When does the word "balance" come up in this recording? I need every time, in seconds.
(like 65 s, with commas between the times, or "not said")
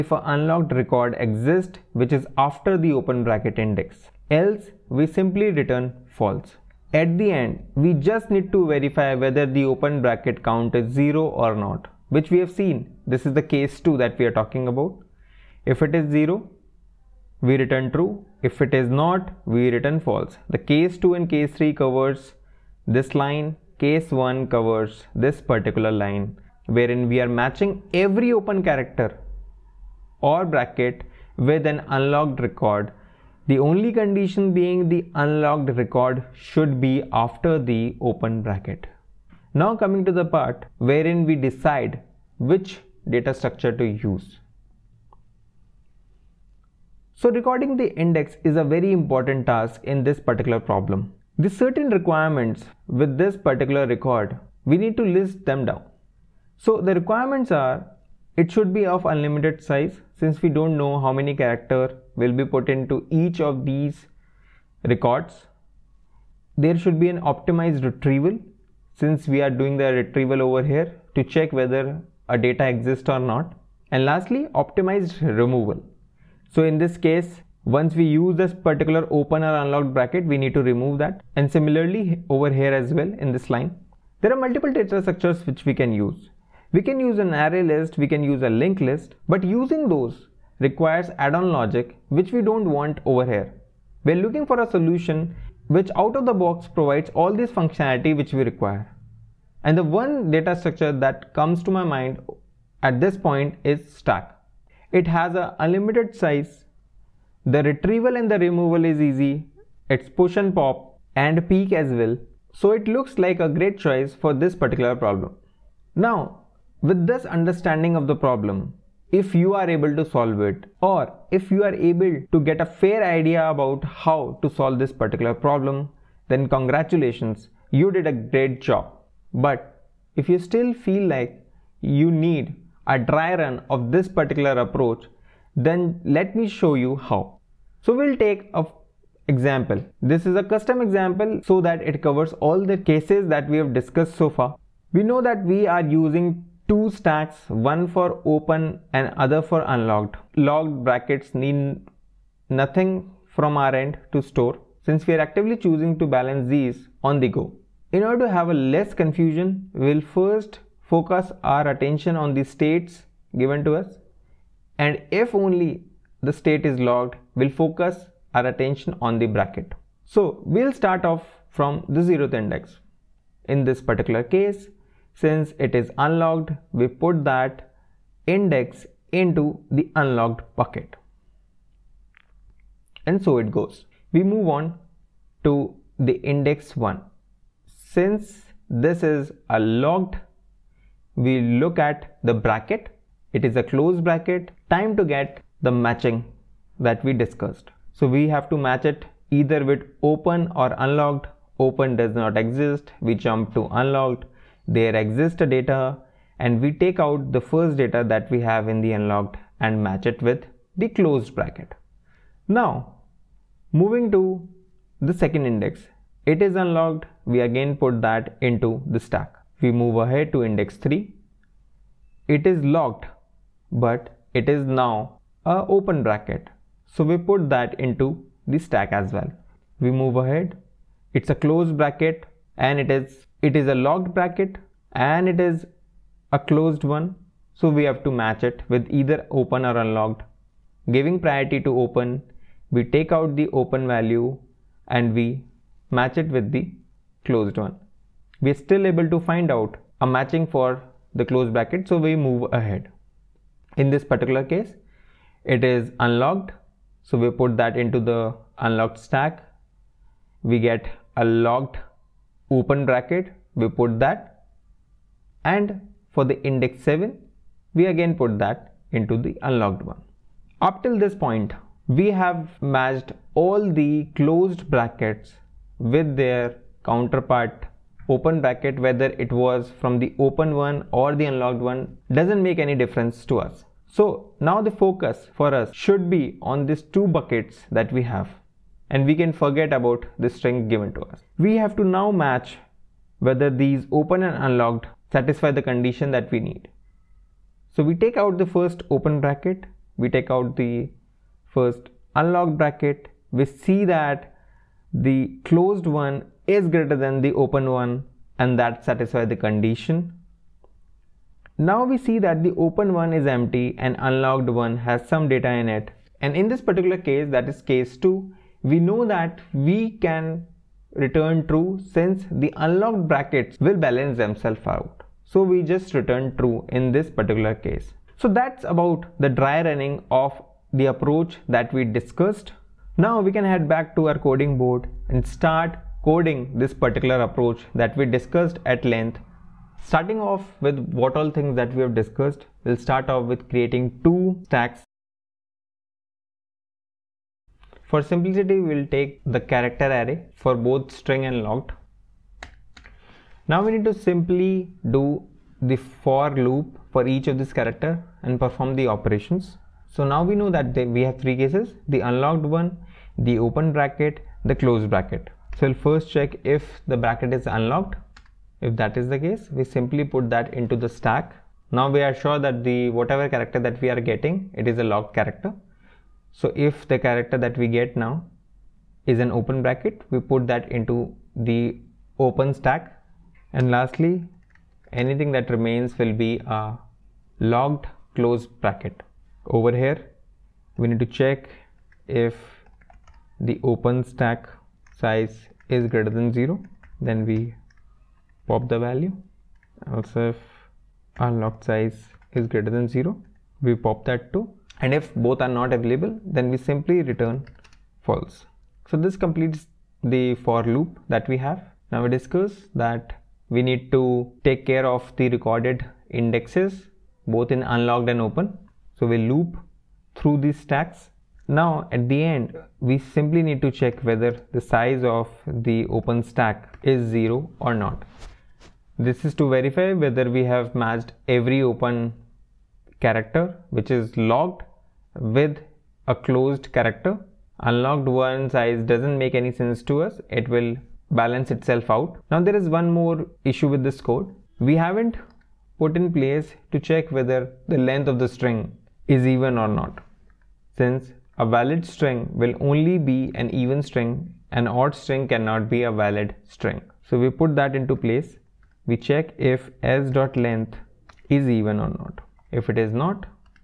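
156 s, 323 s, 441 s.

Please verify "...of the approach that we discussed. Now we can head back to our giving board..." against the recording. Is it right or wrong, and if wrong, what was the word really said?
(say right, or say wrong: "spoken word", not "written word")
wrong: "coding", not "giving".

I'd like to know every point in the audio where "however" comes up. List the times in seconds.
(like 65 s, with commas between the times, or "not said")
not said.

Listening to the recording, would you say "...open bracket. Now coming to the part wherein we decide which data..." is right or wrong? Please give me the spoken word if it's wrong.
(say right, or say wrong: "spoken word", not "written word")
right.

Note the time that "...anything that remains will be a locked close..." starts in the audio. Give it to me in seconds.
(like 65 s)
384 s.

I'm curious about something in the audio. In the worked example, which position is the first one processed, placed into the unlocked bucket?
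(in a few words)
zeroth index.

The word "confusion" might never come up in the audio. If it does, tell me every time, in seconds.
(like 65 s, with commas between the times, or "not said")
158 s.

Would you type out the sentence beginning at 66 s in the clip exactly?
There should be an optimized retrieval since we are doing the retrieval over here to check whether a data exists or not.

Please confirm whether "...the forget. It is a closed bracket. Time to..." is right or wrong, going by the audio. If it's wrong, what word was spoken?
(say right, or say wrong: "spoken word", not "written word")
wrong: "bracket", not "forget".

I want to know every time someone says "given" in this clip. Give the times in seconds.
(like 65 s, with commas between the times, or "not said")
163 s, 290 s.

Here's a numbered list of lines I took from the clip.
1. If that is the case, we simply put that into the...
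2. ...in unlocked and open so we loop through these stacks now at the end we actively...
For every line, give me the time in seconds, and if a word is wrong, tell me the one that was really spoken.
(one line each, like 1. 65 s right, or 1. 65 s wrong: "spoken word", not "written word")
1. 368 s right
2. 417 s wrong: "simply", not "actively".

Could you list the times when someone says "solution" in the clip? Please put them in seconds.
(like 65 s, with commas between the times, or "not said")
94 s.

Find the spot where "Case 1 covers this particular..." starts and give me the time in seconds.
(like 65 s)
23 s.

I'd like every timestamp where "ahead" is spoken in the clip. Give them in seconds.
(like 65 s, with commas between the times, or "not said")
219 s, 230 s, 252 s.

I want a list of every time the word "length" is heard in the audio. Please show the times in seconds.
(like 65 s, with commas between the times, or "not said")
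338 s, 447 s, 460 s.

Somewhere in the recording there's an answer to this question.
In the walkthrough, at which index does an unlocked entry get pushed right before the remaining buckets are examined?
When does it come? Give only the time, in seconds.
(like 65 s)
266 s.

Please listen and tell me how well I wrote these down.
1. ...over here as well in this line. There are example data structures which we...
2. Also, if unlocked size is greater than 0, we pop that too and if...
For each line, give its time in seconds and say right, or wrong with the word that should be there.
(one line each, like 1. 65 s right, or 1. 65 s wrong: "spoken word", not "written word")
1. 82 s wrong: "multiple", not "example"
2. 399 s right.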